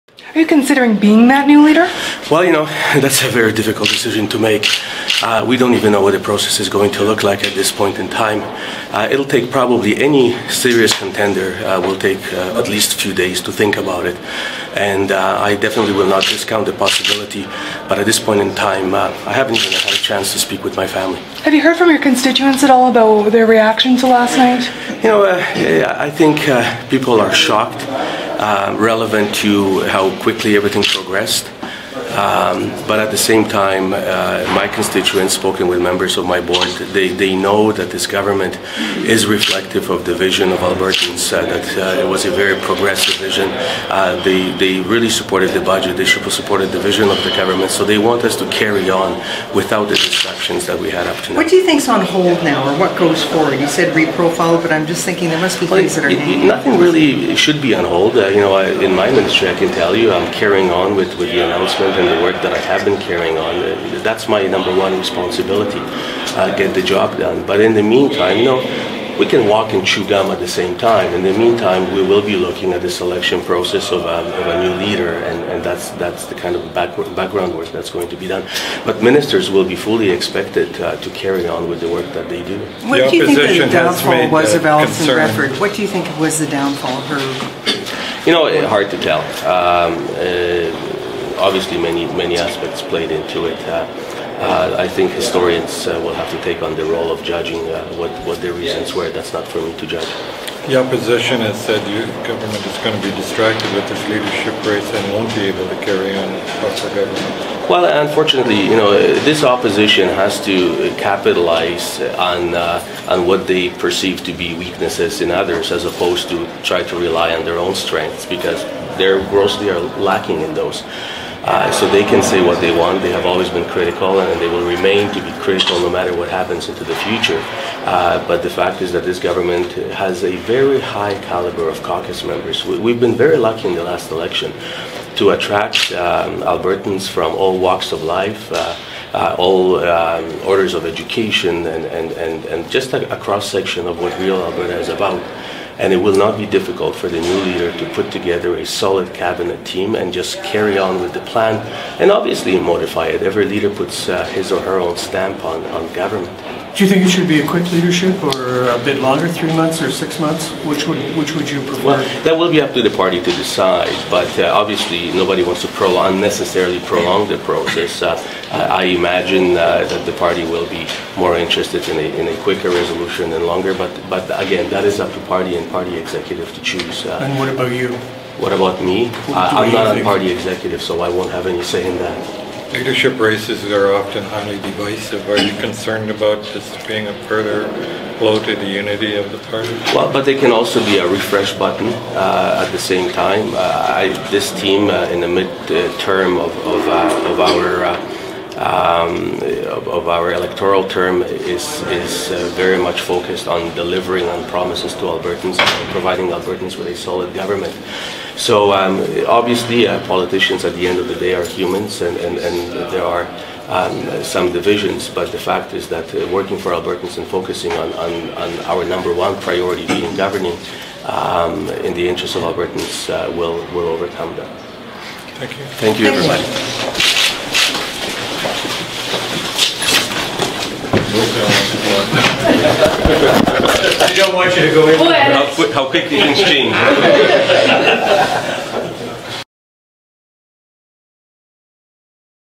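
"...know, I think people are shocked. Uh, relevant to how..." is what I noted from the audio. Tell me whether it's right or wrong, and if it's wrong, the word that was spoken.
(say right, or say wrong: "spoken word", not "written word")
right.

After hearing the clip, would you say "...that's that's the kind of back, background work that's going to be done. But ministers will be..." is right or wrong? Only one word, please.
right.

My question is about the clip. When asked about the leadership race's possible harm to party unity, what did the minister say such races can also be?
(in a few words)
a refresh button.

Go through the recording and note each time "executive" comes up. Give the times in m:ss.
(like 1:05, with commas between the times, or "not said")
2:55, 3:00.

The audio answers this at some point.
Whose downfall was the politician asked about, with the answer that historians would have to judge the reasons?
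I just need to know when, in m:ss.
1:24.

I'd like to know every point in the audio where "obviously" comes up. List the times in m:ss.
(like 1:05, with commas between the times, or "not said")
1:31, 2:32, 2:44, 3:29.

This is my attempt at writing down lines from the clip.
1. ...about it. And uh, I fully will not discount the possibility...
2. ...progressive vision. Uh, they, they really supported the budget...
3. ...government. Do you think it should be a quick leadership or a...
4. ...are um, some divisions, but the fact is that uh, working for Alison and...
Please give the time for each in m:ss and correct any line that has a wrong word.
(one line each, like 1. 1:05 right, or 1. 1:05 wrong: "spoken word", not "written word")
1. 0:13 wrong: "definitely", not "fully"
2. 0:42 right
3. 2:35 right
4. 3:33 wrong: "Albertans", not "Alison".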